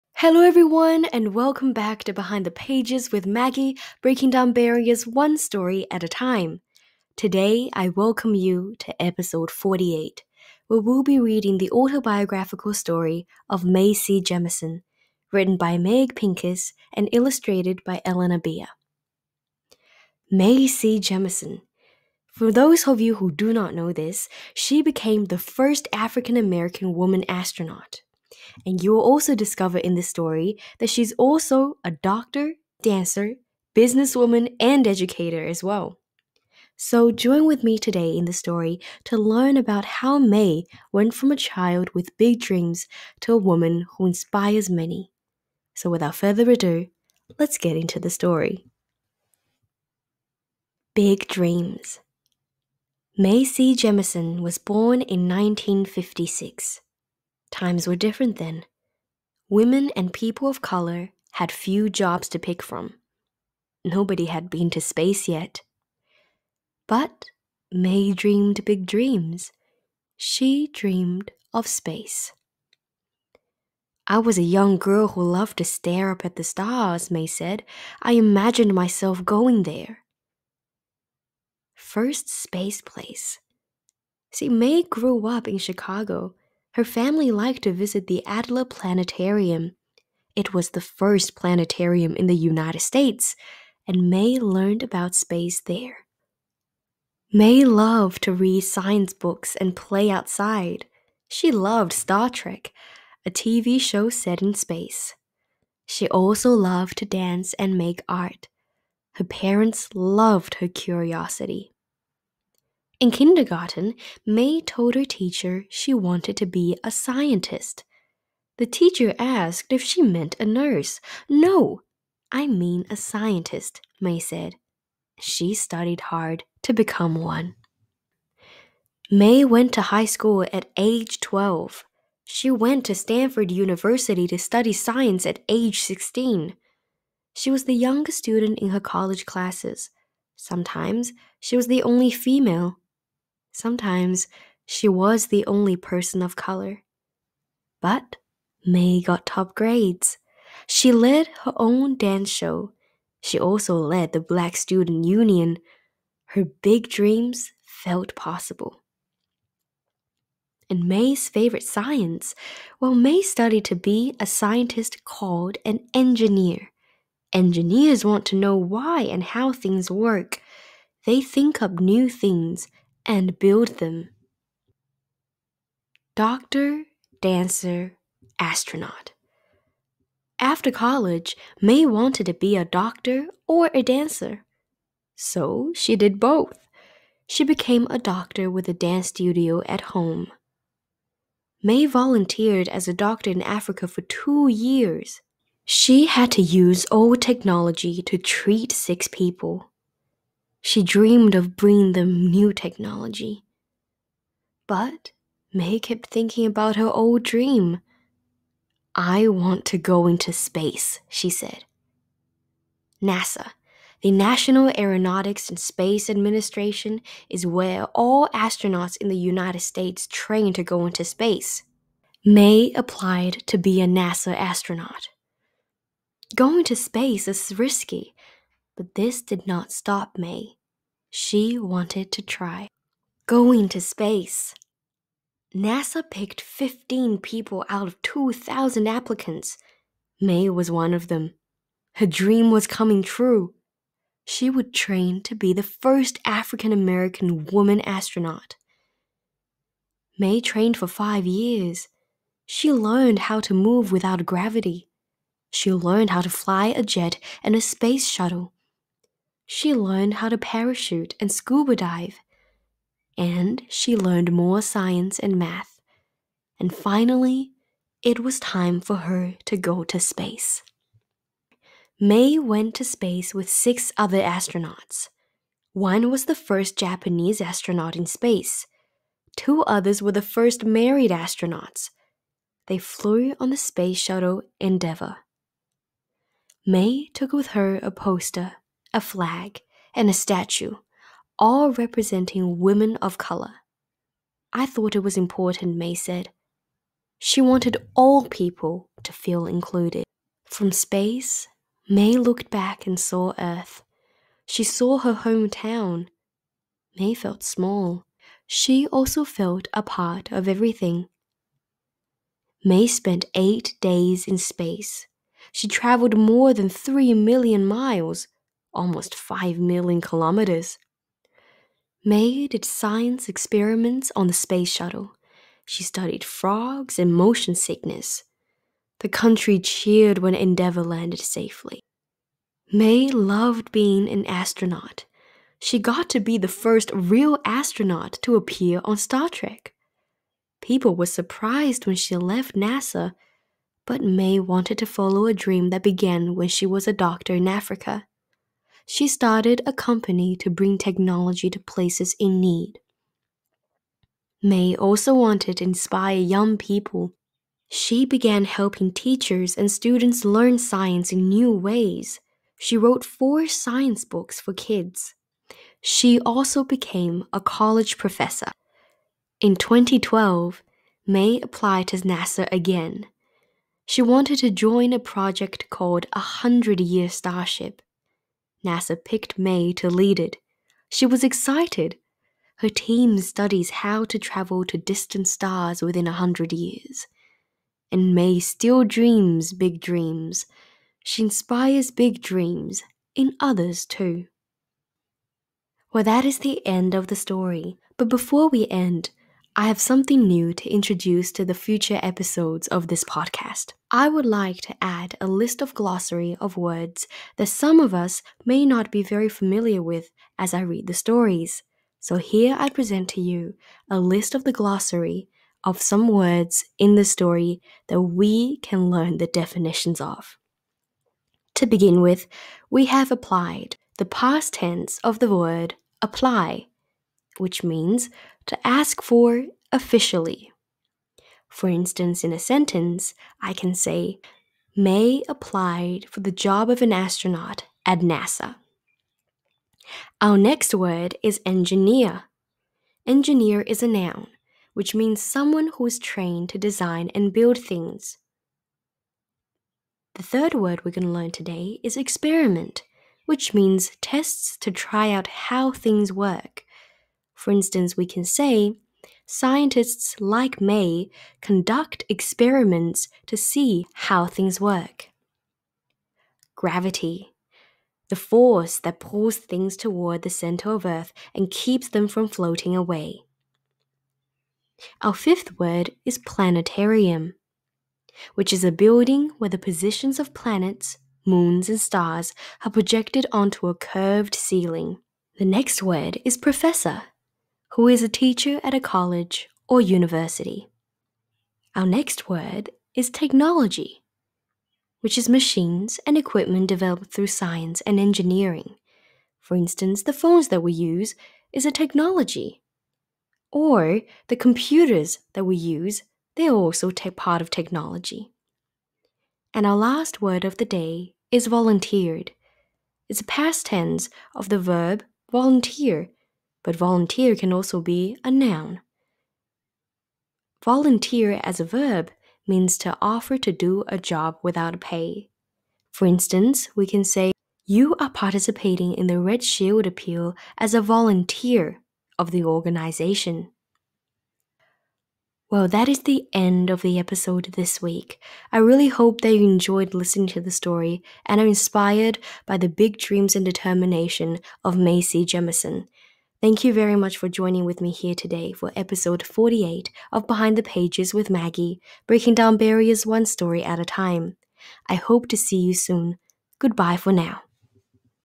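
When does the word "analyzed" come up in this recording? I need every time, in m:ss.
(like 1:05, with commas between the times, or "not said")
not said.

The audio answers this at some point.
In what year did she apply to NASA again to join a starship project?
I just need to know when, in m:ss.
6:09.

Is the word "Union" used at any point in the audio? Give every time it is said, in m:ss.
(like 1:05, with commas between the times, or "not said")
2:35.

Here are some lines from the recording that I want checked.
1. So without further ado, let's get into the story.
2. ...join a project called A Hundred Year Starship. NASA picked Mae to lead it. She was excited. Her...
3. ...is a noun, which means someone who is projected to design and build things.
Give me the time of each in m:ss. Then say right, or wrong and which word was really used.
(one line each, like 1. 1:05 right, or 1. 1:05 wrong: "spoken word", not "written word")
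1. 0:45 right
2. 6:14 right
3. 7:23 wrong: "trained", not "projected".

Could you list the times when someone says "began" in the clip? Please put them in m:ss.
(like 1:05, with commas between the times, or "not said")
5:45, 5:58.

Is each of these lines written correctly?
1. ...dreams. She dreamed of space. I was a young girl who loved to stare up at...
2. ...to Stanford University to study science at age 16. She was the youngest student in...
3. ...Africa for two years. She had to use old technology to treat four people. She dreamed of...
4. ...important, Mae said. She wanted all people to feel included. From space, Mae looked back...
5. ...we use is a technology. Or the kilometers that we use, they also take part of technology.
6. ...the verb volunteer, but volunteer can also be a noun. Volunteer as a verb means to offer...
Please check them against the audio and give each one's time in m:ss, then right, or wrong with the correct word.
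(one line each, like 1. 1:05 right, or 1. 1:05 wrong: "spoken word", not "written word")
1. 1:08 right
2. 2:12 right
3. 3:13 wrong: "six", not "four"
4. 4:55 right
5. 8:20 wrong: "computers", not "kilometers"
6. 8:34 right.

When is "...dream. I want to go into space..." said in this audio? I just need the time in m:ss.
3:27.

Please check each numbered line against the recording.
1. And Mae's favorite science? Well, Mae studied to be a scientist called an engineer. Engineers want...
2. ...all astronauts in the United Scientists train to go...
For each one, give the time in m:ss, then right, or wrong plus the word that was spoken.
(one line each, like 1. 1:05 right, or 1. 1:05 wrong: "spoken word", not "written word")
1. 2:40 right
2. 3:37 wrong: "States", not "Scientists".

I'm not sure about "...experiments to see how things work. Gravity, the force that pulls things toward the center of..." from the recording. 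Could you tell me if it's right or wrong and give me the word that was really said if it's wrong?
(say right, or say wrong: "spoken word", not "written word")
right.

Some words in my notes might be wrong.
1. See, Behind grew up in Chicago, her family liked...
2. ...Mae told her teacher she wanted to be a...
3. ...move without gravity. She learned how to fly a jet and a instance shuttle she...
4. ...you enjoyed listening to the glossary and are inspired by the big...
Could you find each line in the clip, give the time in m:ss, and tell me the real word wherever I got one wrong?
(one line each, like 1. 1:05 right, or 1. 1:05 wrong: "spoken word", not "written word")
1. 1:24 wrong: "Mae", not "Behind"
2. 1:54 right
3. 4:13 wrong: "space", not "instance"
4. 8:59 wrong: "story", not "glossary".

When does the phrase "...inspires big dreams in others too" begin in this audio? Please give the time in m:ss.
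6:31.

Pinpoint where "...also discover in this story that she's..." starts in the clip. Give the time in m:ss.
0:29.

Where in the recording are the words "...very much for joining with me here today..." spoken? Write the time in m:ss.
9:06.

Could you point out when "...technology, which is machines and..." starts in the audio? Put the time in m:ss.
8:13.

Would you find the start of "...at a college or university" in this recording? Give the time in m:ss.
8:08.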